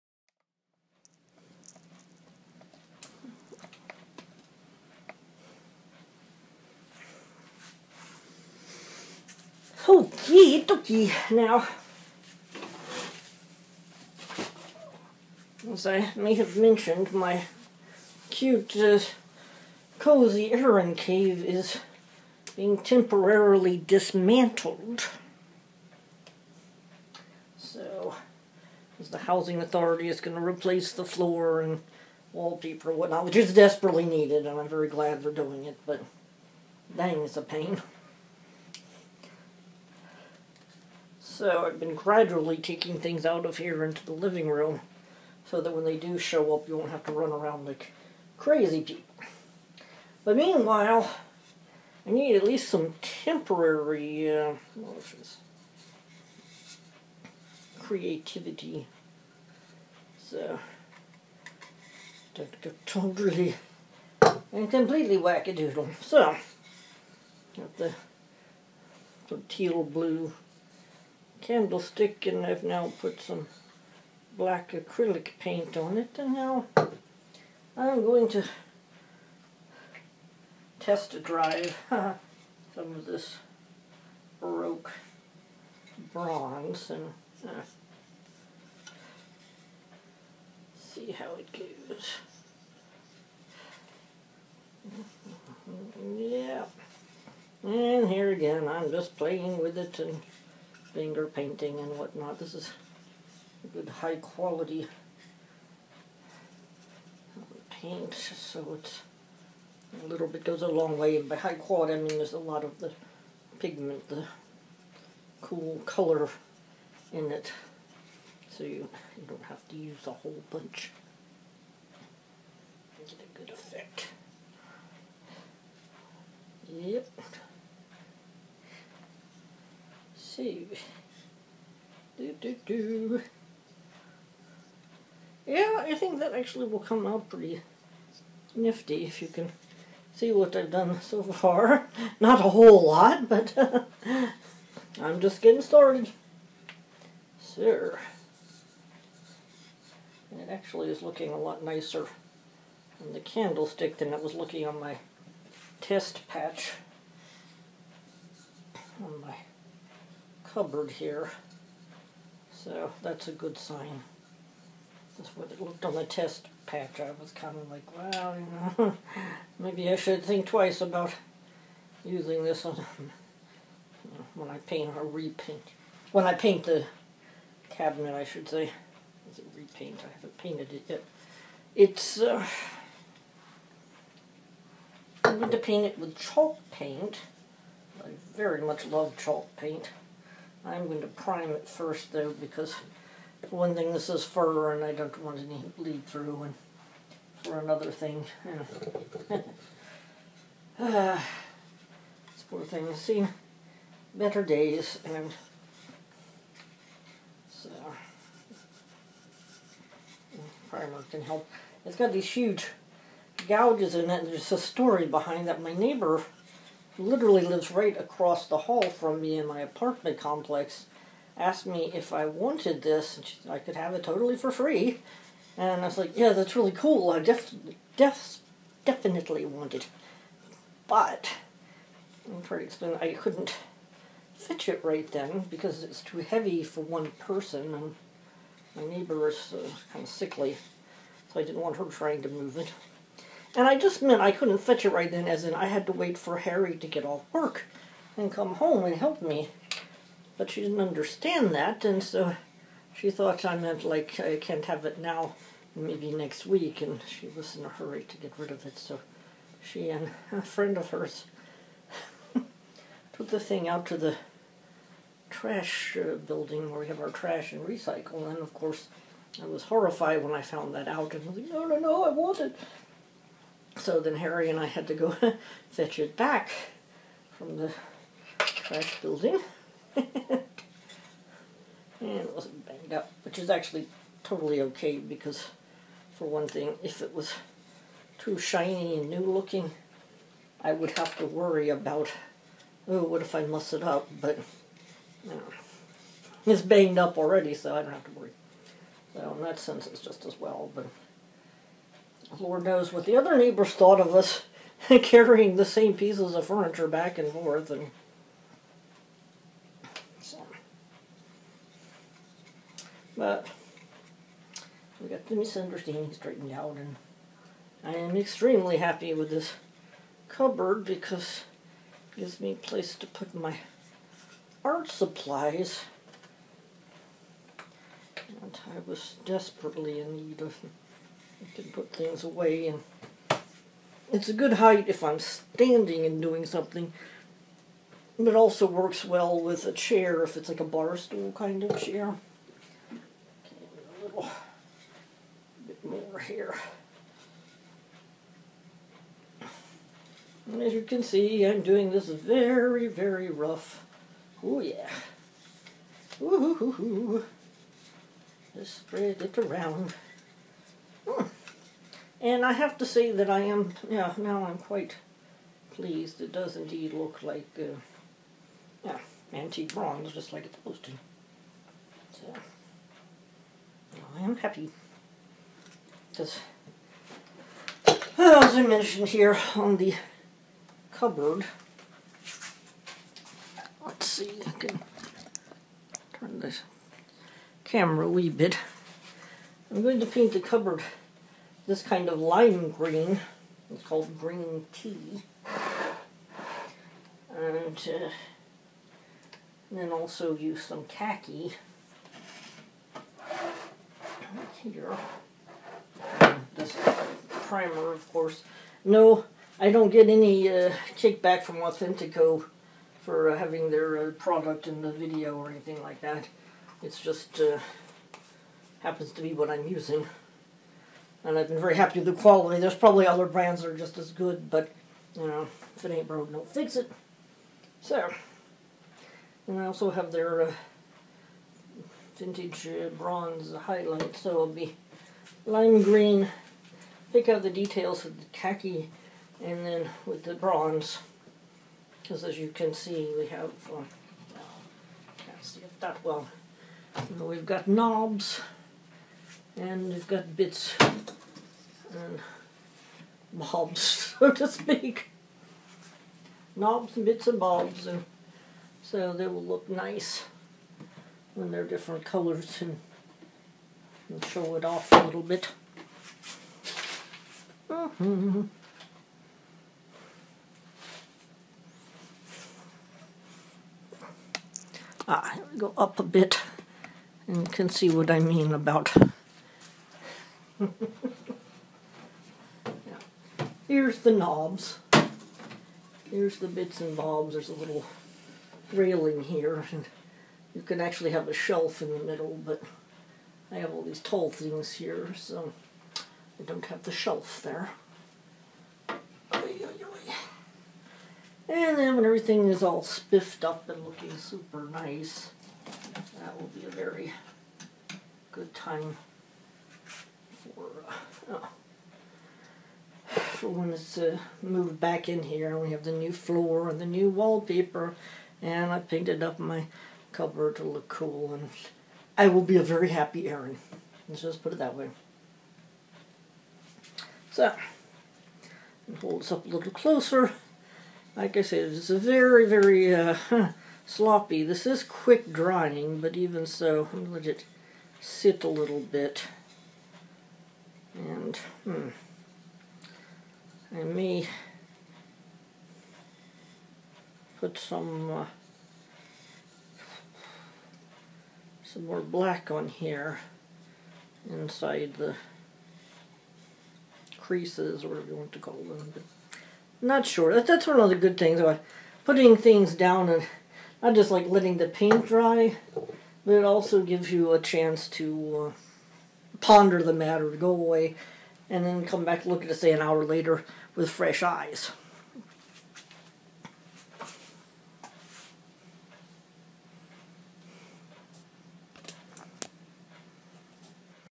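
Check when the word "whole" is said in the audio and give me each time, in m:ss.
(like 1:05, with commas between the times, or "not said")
2:00, 2:22.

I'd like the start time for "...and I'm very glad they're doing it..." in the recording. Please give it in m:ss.
0:34.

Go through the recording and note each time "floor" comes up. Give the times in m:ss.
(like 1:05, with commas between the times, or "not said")
0:31, 8:36.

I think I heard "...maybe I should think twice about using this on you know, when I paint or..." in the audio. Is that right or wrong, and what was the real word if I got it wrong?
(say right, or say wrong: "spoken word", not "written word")
right.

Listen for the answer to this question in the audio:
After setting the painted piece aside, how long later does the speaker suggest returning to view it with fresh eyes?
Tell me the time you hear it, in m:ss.
9:32.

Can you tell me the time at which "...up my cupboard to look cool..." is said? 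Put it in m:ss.
8:39.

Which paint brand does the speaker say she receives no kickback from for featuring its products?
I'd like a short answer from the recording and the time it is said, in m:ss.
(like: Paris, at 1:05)
Autentico, at 6:51.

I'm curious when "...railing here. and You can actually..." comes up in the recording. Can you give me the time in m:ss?
8:08.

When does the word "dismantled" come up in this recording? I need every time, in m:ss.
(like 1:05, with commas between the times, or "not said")
0:23.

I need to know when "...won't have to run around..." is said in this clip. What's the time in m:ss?
0:46.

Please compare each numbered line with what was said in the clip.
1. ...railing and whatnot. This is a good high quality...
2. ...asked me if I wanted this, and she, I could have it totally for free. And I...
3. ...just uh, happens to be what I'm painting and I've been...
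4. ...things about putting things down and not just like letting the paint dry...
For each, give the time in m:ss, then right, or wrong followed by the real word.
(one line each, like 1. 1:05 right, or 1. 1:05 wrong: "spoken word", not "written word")
1. 1:41 wrong: "painting", not "railing"
2. 3:41 right
3. 6:56 wrong: "using", not "painting"
4. 9:21 right.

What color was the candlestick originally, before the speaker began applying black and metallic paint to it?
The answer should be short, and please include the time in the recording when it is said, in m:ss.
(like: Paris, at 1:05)
teal blue, at 1:09.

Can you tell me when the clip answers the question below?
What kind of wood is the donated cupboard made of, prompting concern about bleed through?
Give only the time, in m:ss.
3:14.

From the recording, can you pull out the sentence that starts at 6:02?
And I have to say that I am, yeah, now I'm quite pleased.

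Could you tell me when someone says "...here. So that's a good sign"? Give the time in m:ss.
2:40.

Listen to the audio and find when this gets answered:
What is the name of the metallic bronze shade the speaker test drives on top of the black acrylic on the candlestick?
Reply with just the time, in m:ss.
1:24.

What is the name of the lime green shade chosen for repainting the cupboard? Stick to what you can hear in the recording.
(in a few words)
green tea.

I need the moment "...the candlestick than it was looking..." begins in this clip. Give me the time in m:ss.
2:33.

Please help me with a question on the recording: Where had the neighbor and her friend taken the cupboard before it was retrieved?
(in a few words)
the trash building.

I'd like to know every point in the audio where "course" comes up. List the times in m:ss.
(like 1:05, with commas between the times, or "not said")
4:28, 6:48.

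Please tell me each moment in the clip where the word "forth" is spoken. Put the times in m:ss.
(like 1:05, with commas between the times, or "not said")
5:07.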